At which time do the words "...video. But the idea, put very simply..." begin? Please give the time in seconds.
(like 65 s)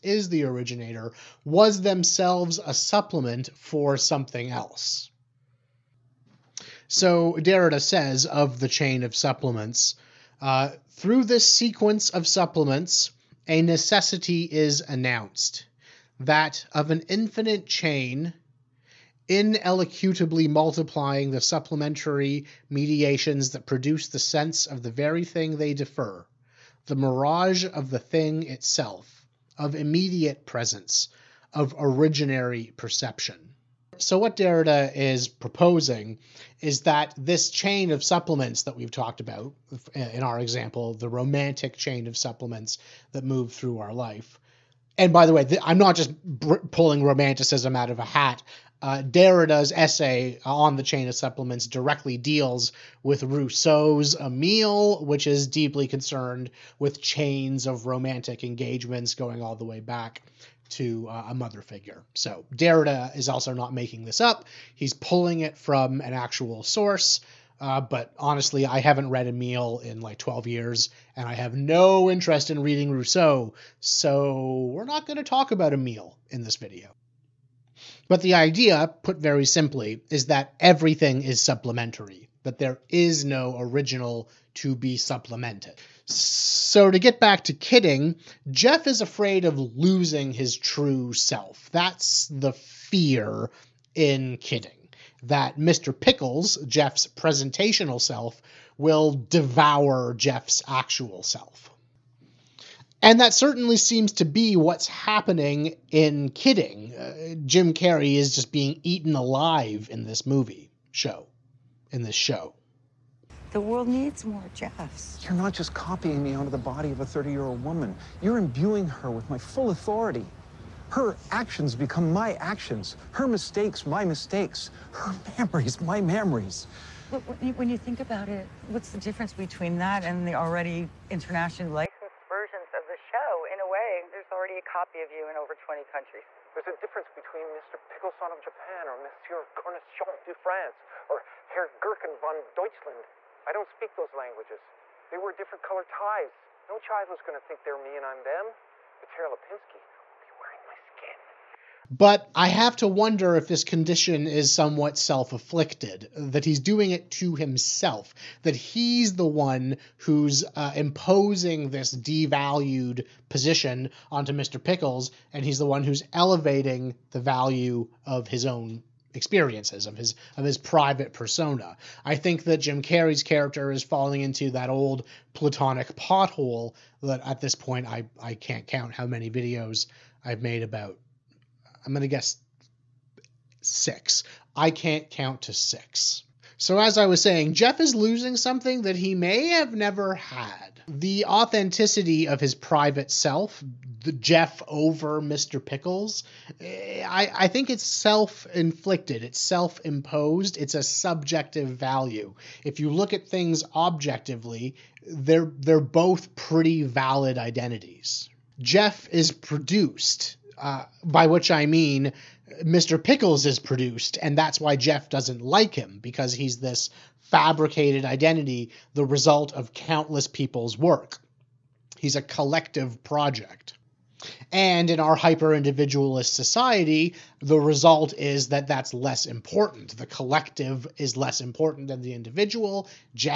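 76 s.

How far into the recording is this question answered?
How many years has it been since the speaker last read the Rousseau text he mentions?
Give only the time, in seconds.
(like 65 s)
70 s.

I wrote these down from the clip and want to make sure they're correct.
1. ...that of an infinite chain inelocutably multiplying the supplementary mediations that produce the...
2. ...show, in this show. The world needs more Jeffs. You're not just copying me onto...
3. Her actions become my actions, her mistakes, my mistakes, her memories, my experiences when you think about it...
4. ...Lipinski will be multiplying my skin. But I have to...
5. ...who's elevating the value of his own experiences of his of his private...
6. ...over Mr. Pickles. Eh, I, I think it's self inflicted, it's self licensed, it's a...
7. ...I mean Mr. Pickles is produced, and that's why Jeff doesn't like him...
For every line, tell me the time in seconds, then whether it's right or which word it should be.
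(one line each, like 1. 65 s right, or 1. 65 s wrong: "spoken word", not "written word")
1. 16 s right
2. 110 s right
3. 120 s wrong: "memories", not "experiences"
4. 149 s wrong: "wearing", not "multiplying"
5. 165 s right
6. 194 s wrong: "imposed", not "licensed"
7. 211 s right.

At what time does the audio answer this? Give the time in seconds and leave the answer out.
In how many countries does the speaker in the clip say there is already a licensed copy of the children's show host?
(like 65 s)
135 s.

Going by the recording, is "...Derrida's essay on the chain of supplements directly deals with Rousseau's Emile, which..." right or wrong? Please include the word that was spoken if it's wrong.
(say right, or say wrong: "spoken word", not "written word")
right.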